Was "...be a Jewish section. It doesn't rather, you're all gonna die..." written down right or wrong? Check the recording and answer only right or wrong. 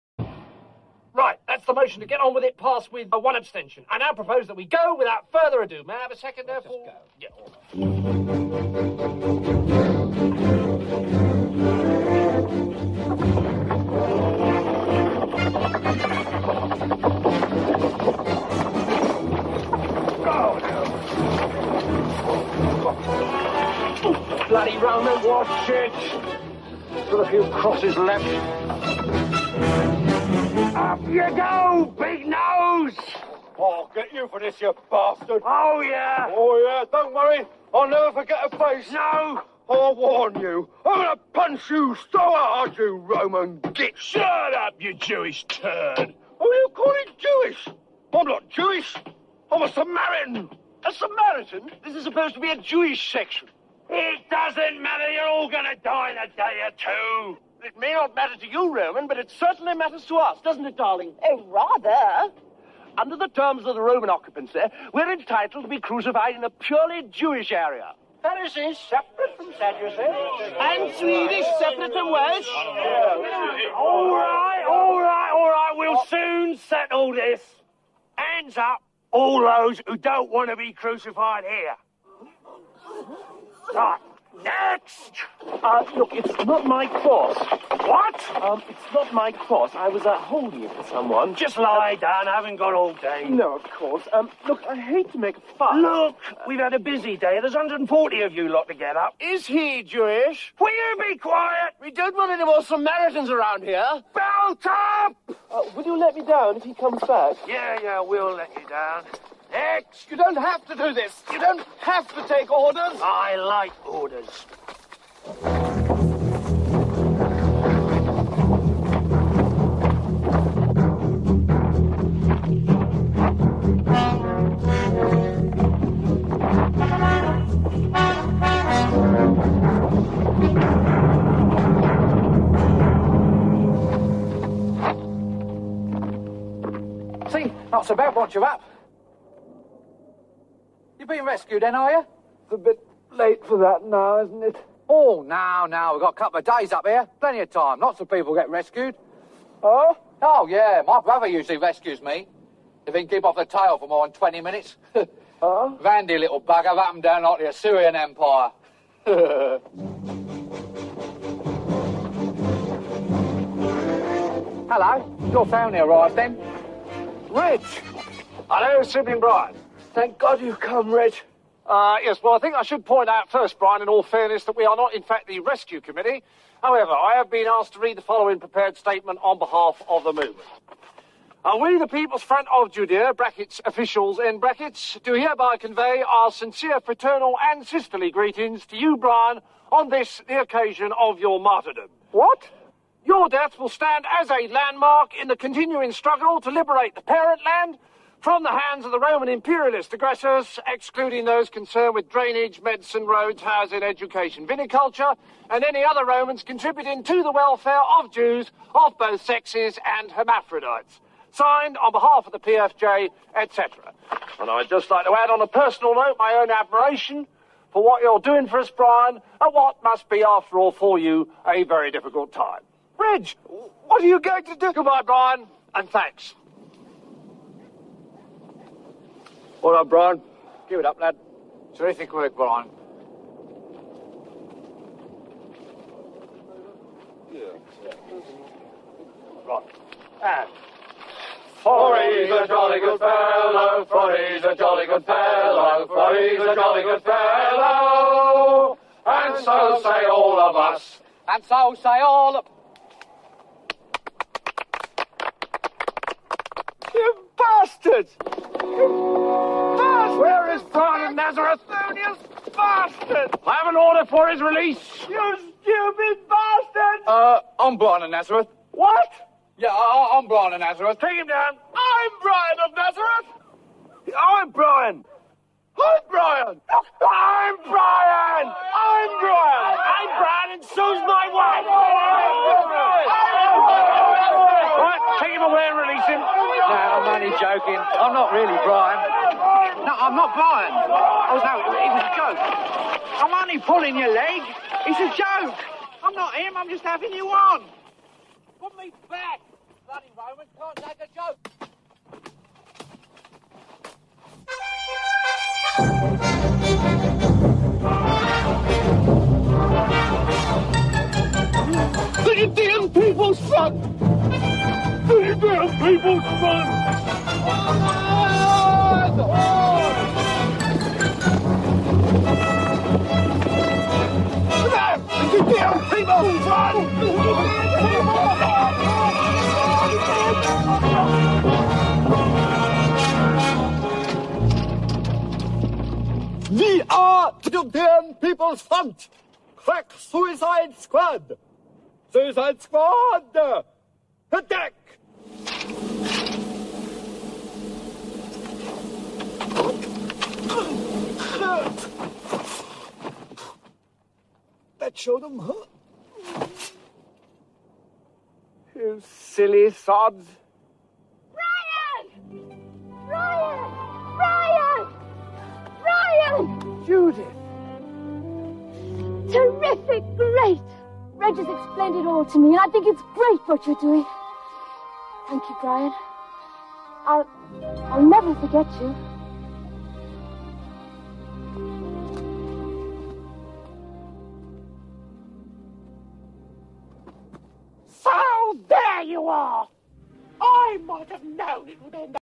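wrong.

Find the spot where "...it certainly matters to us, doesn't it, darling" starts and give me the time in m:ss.
0:59.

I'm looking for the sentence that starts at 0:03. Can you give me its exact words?
I now propose that we go without further ado.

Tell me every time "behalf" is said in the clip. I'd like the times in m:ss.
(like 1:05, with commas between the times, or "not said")
2:59, 3:31.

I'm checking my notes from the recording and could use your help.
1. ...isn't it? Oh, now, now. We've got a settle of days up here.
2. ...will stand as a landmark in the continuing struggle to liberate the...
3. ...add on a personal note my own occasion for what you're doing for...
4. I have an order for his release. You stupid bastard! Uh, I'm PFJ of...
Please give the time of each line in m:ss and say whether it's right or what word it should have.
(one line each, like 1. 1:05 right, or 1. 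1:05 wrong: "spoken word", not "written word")
1. 2:24 wrong: "couple", not "settle"
2. 3:13 right
3. 3:35 wrong: "admiration", not "occasion"
4. 4:23 wrong: "Brian", not "PFJ".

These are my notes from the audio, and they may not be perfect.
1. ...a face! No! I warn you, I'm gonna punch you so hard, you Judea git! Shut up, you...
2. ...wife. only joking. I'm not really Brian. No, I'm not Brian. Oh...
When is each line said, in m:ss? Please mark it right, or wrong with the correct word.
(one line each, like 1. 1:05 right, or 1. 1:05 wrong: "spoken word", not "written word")
1. 0:38 wrong: "Roman", not "Judea"
2. 4:41 right.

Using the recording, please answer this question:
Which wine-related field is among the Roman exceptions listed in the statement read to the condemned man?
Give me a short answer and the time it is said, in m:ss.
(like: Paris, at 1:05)
viniculture, at 3:24.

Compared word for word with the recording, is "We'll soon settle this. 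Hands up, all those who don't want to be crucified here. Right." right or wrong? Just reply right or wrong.
right.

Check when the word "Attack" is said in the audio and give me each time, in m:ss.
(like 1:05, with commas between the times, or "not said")
5:44.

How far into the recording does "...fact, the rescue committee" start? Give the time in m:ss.
2:55.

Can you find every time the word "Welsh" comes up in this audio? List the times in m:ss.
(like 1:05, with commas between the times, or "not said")
1:12.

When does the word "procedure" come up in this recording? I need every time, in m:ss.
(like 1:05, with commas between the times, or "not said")
not said.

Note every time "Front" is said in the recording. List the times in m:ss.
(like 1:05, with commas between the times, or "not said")
3:02, 5:38.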